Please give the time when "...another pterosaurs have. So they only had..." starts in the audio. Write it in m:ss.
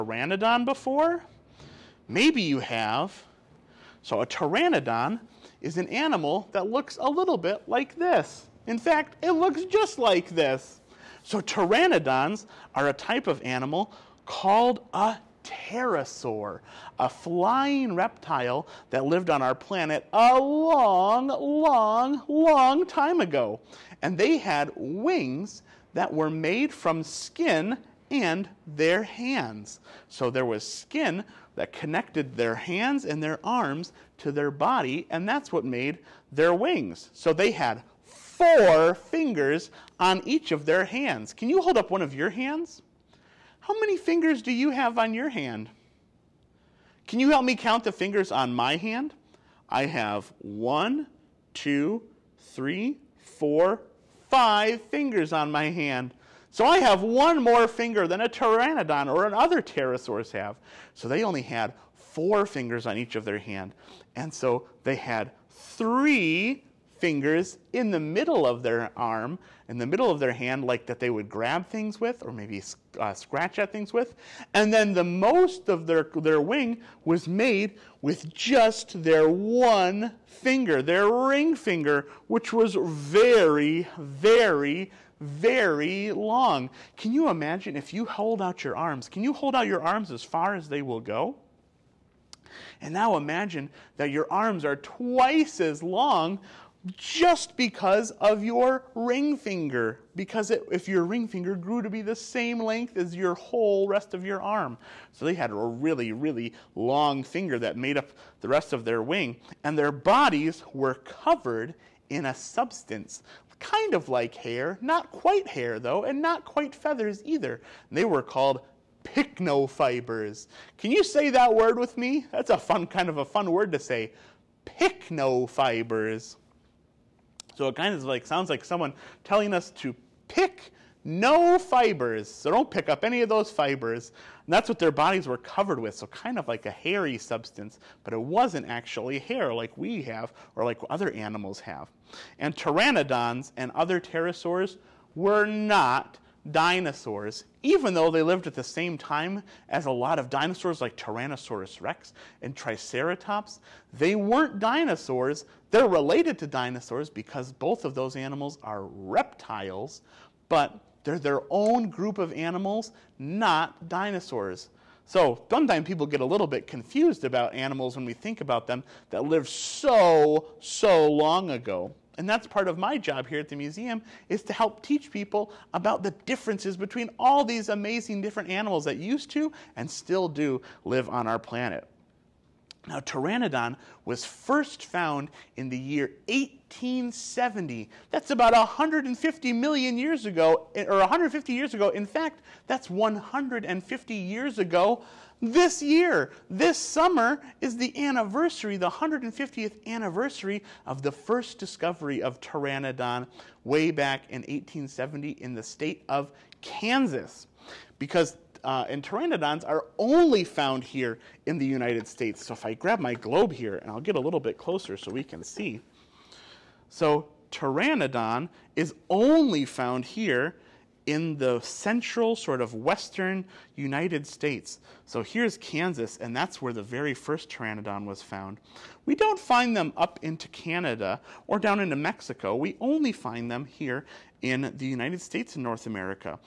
0:59.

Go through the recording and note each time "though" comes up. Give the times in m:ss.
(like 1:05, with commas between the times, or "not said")
1:55, 2:27.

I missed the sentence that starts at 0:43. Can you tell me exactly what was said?
How many fingers do you have on your hand?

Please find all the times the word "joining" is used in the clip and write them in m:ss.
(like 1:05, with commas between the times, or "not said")
not said.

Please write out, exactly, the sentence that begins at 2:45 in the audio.
So sometimes people get a little bit confused about animals when we think about them that lived so, so long ago.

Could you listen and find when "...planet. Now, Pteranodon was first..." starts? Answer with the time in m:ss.
3:01.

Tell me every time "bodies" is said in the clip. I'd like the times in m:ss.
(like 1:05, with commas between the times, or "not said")
1:49, 2:14.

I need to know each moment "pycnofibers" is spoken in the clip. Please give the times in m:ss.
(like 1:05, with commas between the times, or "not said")
1:59, 2:04.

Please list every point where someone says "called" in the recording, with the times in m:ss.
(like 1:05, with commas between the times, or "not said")
0:14, 1:58.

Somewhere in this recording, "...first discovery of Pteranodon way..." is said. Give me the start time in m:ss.
3:21.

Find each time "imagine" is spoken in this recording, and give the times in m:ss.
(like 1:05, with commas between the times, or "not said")
1:27, 1:33.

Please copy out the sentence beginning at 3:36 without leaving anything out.
So pteranodon is only found here in the central sort of western United States.